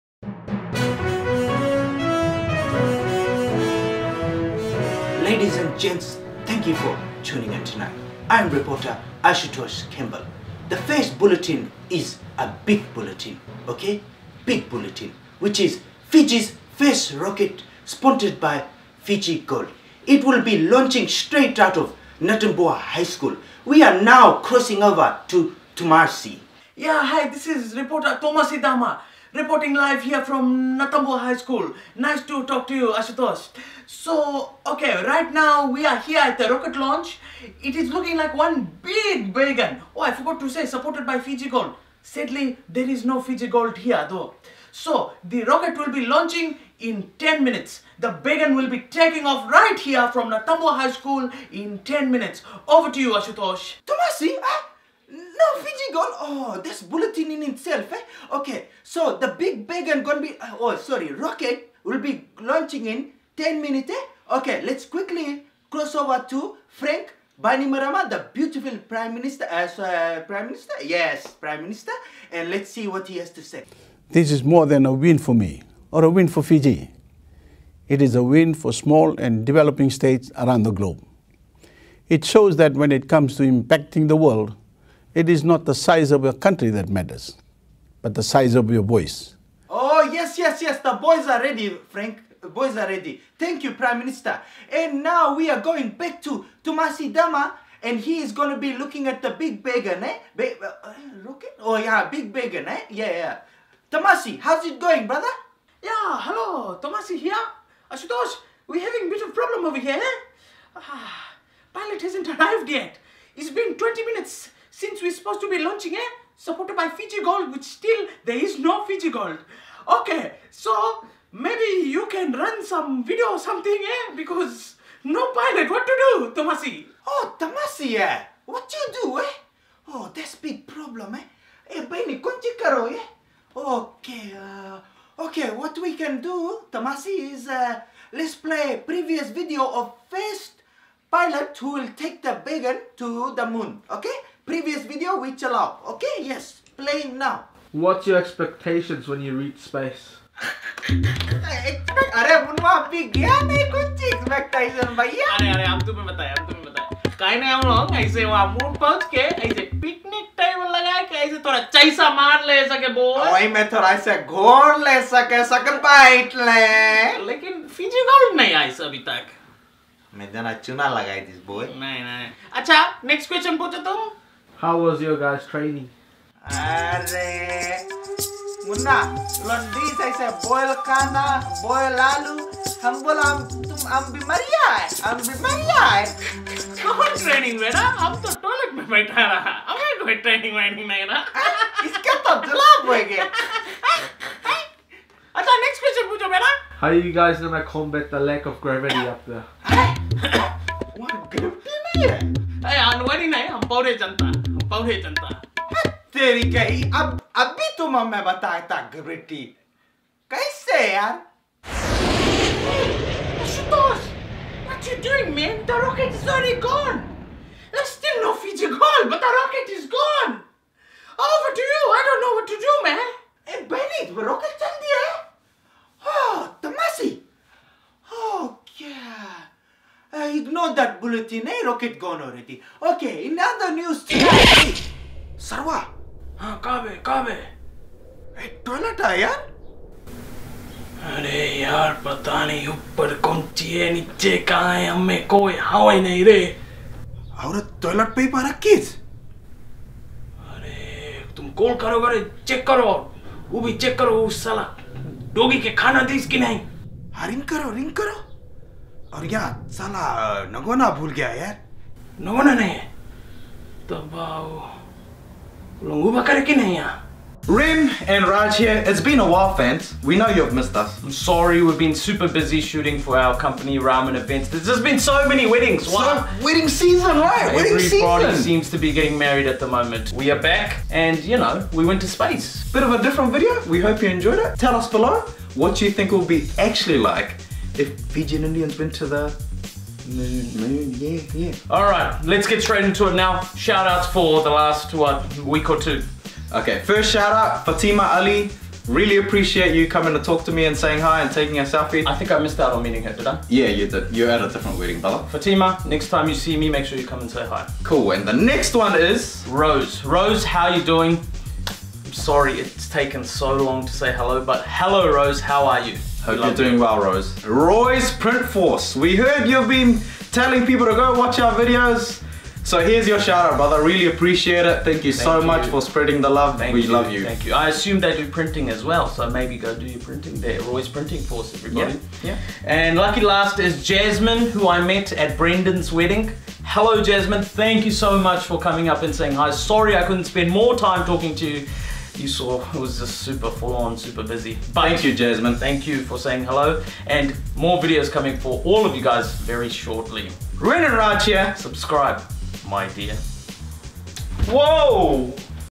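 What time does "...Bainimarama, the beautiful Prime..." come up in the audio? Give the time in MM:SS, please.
01:07.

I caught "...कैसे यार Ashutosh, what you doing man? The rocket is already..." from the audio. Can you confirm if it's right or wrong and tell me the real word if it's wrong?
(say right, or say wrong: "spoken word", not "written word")
right.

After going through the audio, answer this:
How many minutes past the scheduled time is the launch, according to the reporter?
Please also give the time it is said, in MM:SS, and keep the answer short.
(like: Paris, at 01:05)
20, at 01:53.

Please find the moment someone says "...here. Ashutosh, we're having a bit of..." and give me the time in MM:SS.
01:47.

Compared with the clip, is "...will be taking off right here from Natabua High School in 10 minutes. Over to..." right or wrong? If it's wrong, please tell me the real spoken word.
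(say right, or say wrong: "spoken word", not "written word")
right.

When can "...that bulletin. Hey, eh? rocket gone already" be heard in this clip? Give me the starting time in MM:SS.
03:50.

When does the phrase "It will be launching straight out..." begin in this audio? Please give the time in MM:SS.
00:20.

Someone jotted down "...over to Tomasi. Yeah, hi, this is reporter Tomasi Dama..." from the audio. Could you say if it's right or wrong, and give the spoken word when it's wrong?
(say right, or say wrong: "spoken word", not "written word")
right.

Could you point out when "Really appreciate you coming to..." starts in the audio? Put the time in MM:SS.
04:58.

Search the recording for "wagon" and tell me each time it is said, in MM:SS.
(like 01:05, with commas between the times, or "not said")
00:39, 00:48.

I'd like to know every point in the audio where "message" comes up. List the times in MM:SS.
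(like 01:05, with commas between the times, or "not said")
not said.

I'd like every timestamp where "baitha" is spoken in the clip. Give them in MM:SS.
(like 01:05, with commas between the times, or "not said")
03:08.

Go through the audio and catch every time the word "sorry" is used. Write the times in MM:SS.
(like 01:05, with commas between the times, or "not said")
01:00, 04:31, 05:12, 05:39.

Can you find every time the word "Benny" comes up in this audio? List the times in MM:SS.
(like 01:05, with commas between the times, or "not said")
02:11, 03:43.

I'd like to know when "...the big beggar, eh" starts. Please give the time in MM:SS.
01:39.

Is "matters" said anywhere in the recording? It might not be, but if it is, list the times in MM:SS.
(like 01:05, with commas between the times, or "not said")
01:26.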